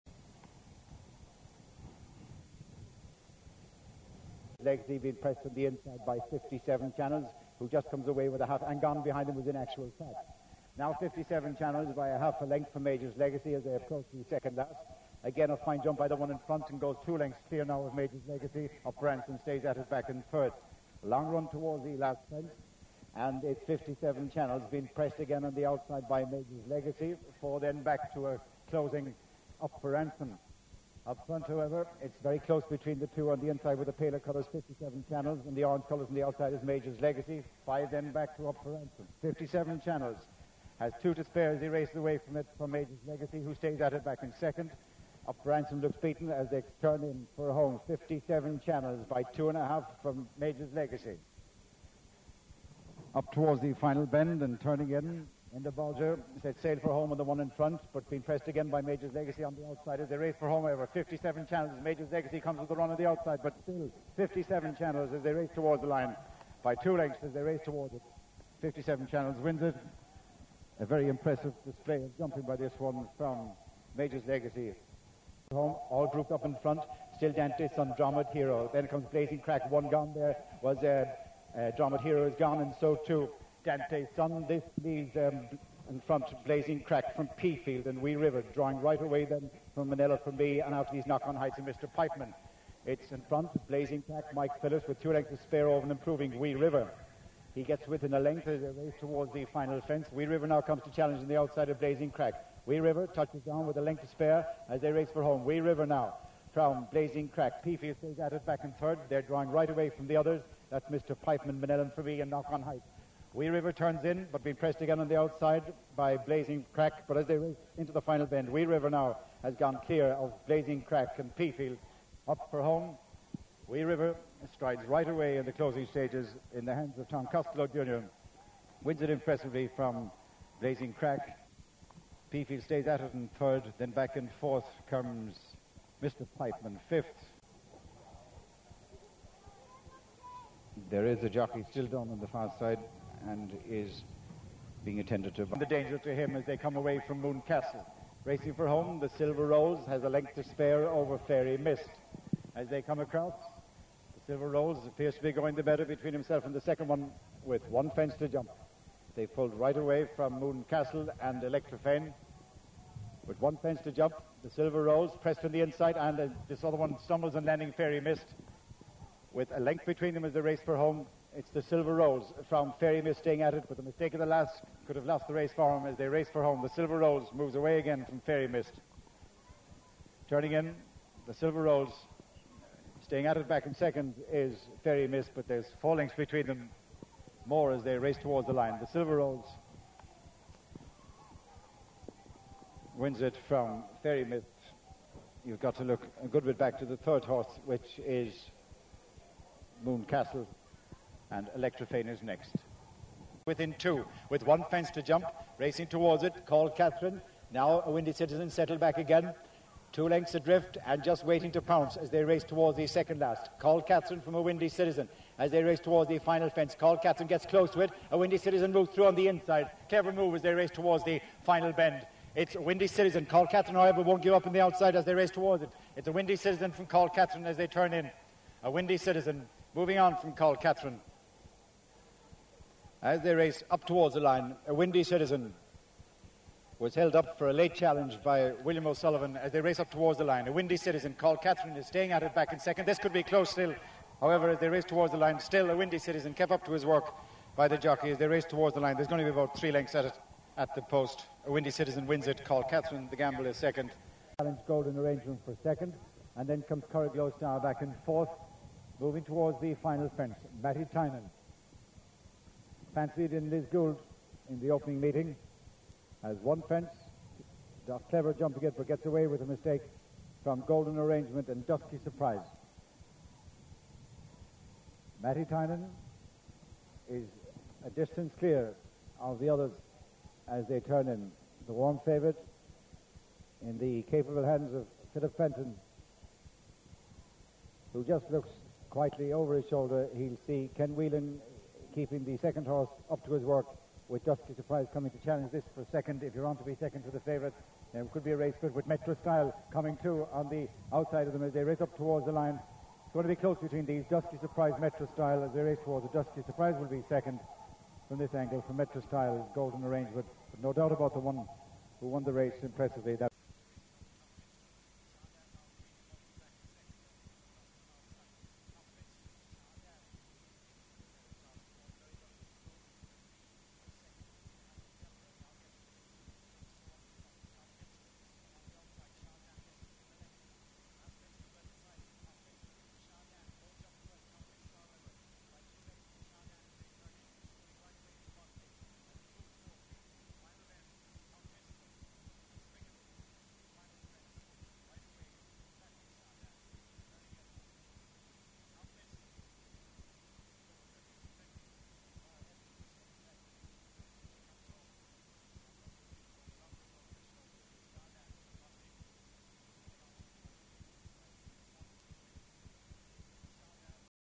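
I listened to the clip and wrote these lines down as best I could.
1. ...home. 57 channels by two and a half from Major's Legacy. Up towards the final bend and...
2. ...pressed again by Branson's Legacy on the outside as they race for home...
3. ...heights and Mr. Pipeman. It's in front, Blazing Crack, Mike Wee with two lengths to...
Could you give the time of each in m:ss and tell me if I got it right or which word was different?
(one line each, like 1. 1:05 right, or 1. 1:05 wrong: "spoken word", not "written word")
1. 0:47 right
2. 0:58 wrong: "Major", not "Branson"
3. 1:31 wrong: "Phillips", not "Wee".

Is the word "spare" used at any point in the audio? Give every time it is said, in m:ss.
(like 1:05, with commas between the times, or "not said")
0:41, 1:35, 1:44, 2:30.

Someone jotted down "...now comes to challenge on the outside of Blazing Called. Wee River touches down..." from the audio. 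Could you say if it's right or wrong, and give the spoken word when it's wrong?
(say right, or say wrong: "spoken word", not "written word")
wrong: "Crack", not "Called".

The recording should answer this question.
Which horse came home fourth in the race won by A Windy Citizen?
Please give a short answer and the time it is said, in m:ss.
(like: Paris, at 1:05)
Corriglow, at 4:16.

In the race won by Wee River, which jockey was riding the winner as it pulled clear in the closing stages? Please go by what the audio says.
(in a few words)
Tom Costello Jr.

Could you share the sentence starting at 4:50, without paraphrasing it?
He'll see Ken Whelan keeping the second horse up to his work with Dusky Surprise coming to challenge this for second.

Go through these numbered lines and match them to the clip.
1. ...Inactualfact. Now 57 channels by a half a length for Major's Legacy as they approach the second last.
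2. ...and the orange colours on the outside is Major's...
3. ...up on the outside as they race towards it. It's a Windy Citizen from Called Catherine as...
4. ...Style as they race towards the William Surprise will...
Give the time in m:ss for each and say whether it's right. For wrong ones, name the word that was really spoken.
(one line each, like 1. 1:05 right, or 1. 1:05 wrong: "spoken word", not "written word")
1. 0:09 right
2. 0:35 right
3. 3:44 right
4. 5:05 wrong: "Dusky", not "William".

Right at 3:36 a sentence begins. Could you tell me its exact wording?
Called Catherine gets close to it.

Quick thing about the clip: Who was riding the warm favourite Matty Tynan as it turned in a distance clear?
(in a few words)
Philip Fenton.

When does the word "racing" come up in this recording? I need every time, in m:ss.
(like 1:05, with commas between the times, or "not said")
2:28, 3:25.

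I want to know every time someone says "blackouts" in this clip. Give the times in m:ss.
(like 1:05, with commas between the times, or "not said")
not said.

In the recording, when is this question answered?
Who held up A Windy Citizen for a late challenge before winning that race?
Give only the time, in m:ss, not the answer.
3:58.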